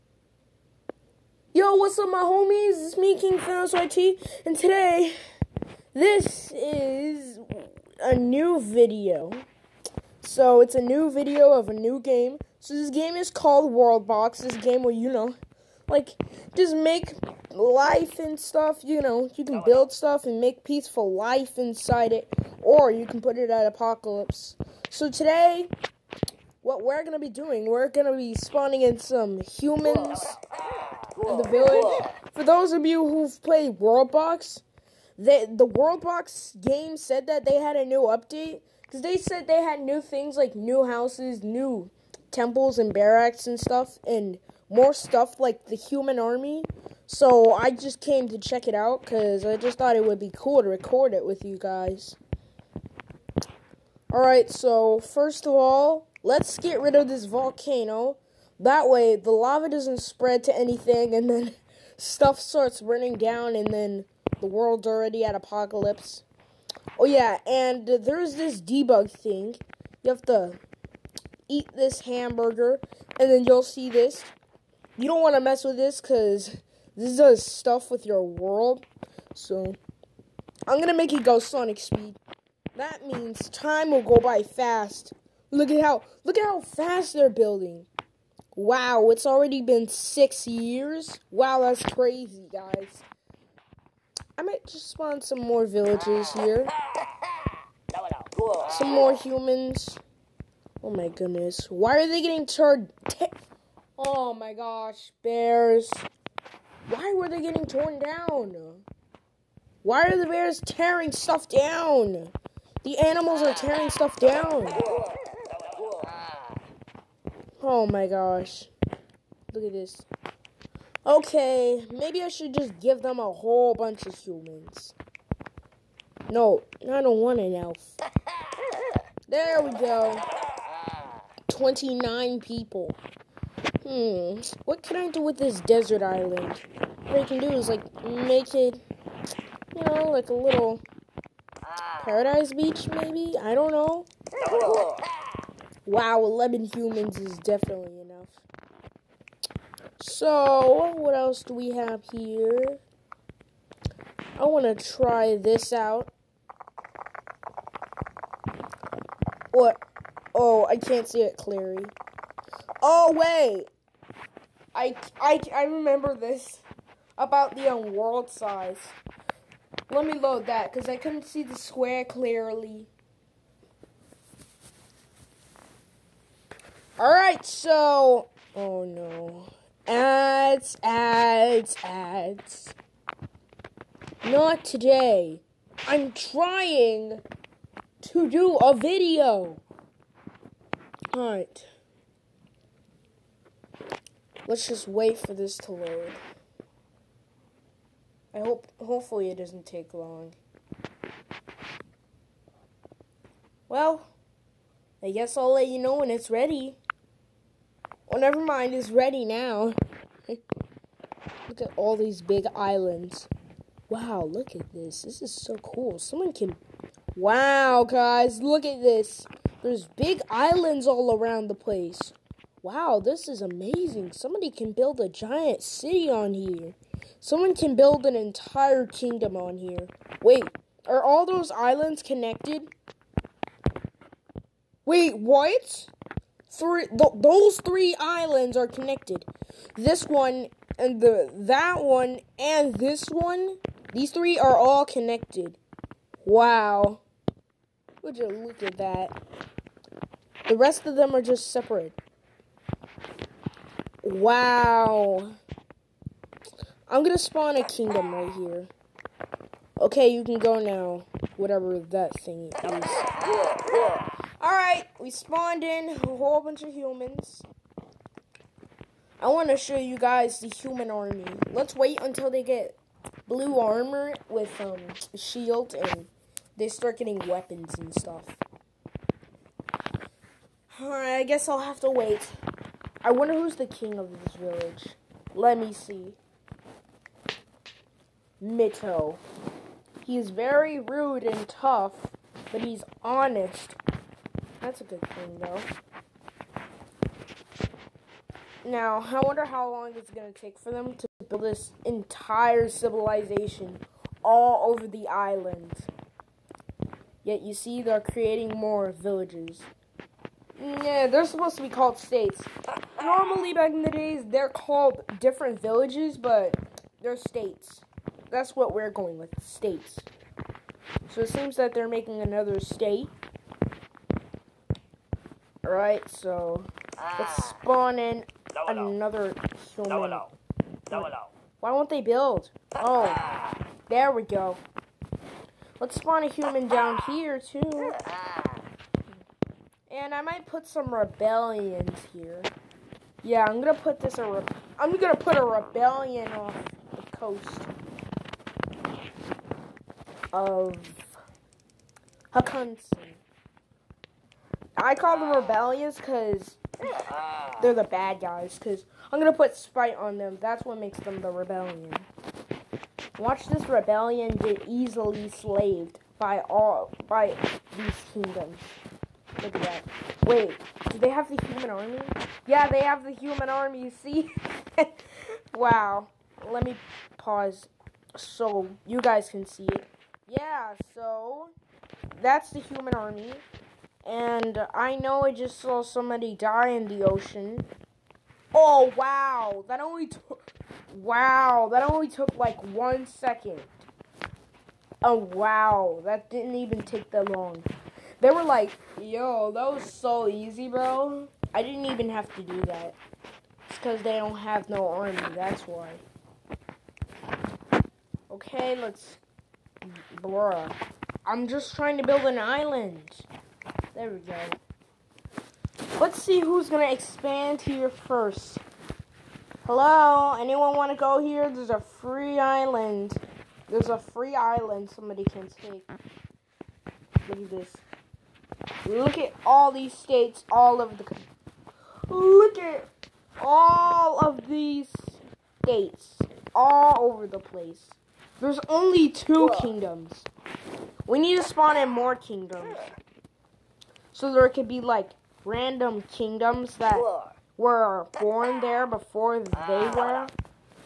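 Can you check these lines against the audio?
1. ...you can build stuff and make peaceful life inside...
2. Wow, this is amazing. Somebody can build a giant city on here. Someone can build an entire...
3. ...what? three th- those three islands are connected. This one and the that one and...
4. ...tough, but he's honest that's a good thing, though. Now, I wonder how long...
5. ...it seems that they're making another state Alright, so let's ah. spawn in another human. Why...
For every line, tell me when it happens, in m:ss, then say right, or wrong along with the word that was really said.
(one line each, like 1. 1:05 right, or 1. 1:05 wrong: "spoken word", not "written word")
1. 0:19 right
2. 3:42 right
3. 3:55 right
4. 4:51 right
5. 5:21 right.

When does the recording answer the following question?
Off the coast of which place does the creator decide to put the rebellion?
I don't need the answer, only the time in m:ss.
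5:52.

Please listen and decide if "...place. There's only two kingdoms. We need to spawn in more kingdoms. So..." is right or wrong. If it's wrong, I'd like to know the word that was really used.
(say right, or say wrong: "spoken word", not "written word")
right.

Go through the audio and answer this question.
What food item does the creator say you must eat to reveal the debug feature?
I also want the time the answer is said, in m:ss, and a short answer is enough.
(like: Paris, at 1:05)
hamburger, at 1:12.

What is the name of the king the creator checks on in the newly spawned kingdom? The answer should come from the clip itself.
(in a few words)
Mito.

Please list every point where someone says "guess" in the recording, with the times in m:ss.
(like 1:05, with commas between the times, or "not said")
3:25, 4:41.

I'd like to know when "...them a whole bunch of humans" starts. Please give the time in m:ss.
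2:03.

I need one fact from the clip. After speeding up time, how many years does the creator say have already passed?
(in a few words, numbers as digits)
6.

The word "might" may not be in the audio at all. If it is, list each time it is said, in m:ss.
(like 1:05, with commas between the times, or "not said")
1:34, 5:40.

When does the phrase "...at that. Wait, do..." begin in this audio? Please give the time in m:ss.
6:09.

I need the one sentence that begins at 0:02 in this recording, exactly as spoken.
It's me, King Thanos YT, and today, this is a new video.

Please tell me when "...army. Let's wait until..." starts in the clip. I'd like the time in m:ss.
4:30.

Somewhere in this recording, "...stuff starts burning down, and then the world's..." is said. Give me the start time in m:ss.
1:01.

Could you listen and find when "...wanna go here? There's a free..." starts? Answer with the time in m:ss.
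7:00.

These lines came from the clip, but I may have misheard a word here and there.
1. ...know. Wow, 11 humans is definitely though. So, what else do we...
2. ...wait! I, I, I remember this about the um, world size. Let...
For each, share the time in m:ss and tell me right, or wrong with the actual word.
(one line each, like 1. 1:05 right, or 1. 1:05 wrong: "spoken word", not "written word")
1. 2:23 wrong: "enough", not "though"
2. 2:43 right.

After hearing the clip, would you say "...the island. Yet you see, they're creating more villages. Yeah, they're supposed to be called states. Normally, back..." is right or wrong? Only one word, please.
right.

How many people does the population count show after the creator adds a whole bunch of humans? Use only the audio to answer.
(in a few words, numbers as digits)
29.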